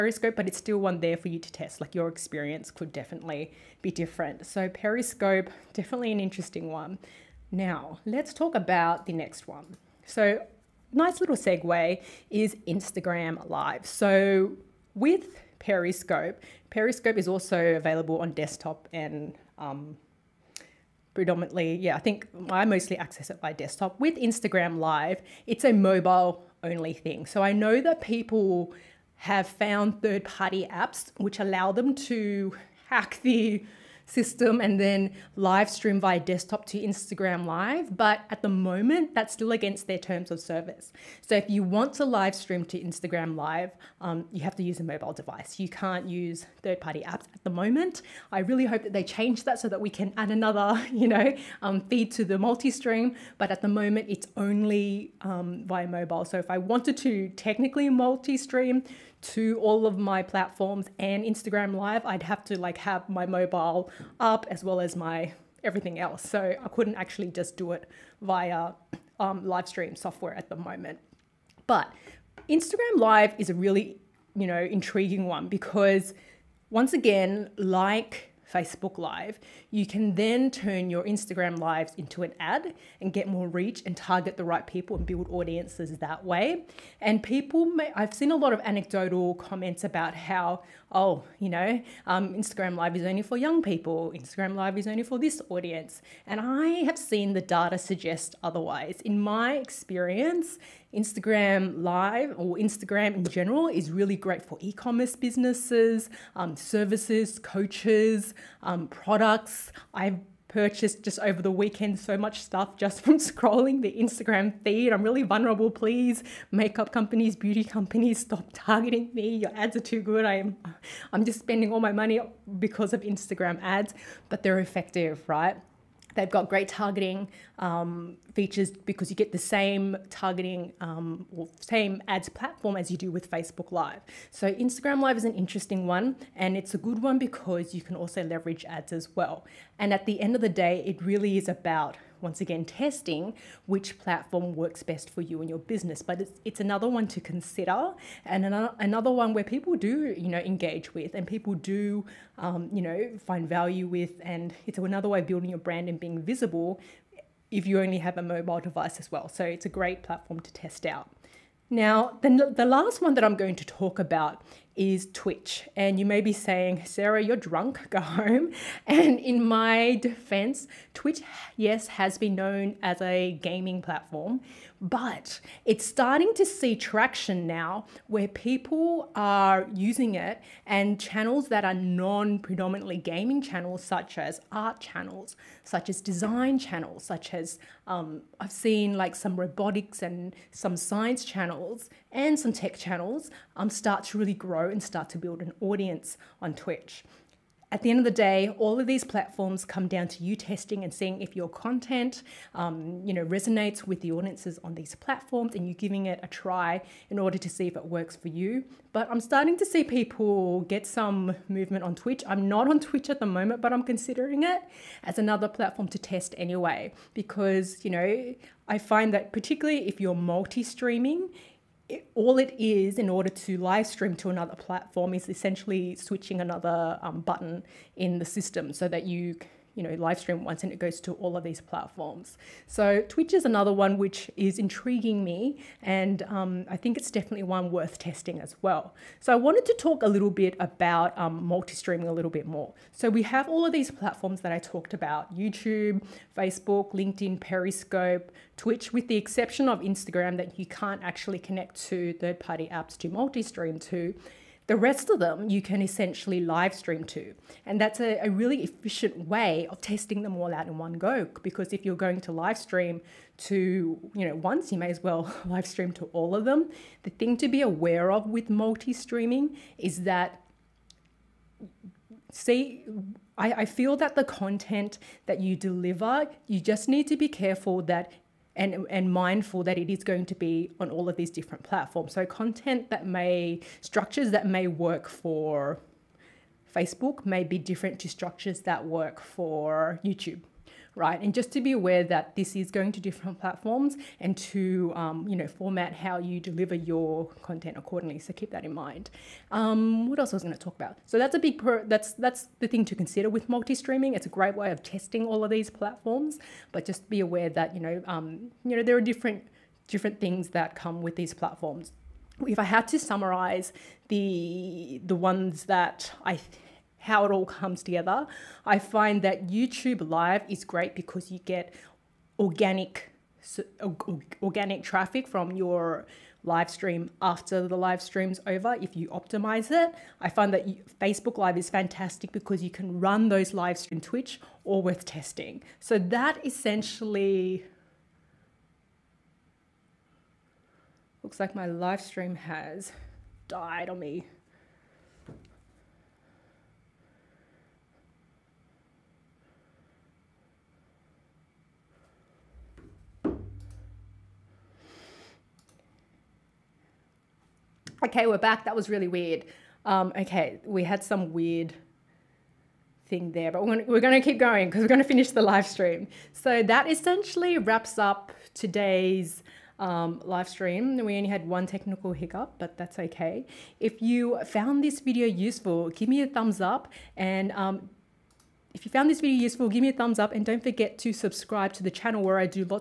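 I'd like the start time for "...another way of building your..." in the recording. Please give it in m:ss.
2:34.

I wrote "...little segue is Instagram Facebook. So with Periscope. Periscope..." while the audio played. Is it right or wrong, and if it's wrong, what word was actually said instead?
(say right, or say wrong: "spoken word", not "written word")
wrong: "Live", not "Facebook".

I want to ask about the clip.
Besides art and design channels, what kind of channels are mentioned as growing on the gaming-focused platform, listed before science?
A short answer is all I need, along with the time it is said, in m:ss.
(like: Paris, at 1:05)
robotics, at 3:09.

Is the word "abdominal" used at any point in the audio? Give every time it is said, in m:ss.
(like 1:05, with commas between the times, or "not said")
not said.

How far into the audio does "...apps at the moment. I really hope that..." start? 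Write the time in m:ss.
0:47.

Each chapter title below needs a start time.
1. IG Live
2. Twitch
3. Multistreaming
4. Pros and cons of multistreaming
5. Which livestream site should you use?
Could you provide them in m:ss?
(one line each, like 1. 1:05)
1. 0:08
2. 2:40
3. 4:01
4. 4:31
5. 5:14.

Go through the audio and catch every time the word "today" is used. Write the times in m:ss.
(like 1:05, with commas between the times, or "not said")
6:08.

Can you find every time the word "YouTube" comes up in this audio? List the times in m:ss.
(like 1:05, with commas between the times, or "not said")
4:05, 4:50, 5:19.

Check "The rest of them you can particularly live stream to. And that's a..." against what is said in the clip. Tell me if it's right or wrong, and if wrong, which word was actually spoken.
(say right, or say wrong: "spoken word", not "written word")
wrong: "essentially", not "particularly".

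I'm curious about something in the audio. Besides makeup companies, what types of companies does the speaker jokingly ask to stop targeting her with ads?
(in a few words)
beauty companies.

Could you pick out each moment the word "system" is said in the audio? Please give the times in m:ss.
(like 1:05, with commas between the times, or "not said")
0:34, 3:48.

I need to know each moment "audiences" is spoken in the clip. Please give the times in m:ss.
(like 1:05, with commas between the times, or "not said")
1:25, 1:35, 3:15, 3:24.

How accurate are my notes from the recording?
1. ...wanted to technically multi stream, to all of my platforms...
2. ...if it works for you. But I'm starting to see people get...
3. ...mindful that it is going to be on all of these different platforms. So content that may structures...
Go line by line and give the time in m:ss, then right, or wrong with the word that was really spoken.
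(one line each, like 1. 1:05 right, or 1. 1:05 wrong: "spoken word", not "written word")
1. 0:56 right
2. 3:27 right
3. 4:39 right.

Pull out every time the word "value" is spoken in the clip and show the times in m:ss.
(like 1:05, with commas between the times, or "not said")
2:33.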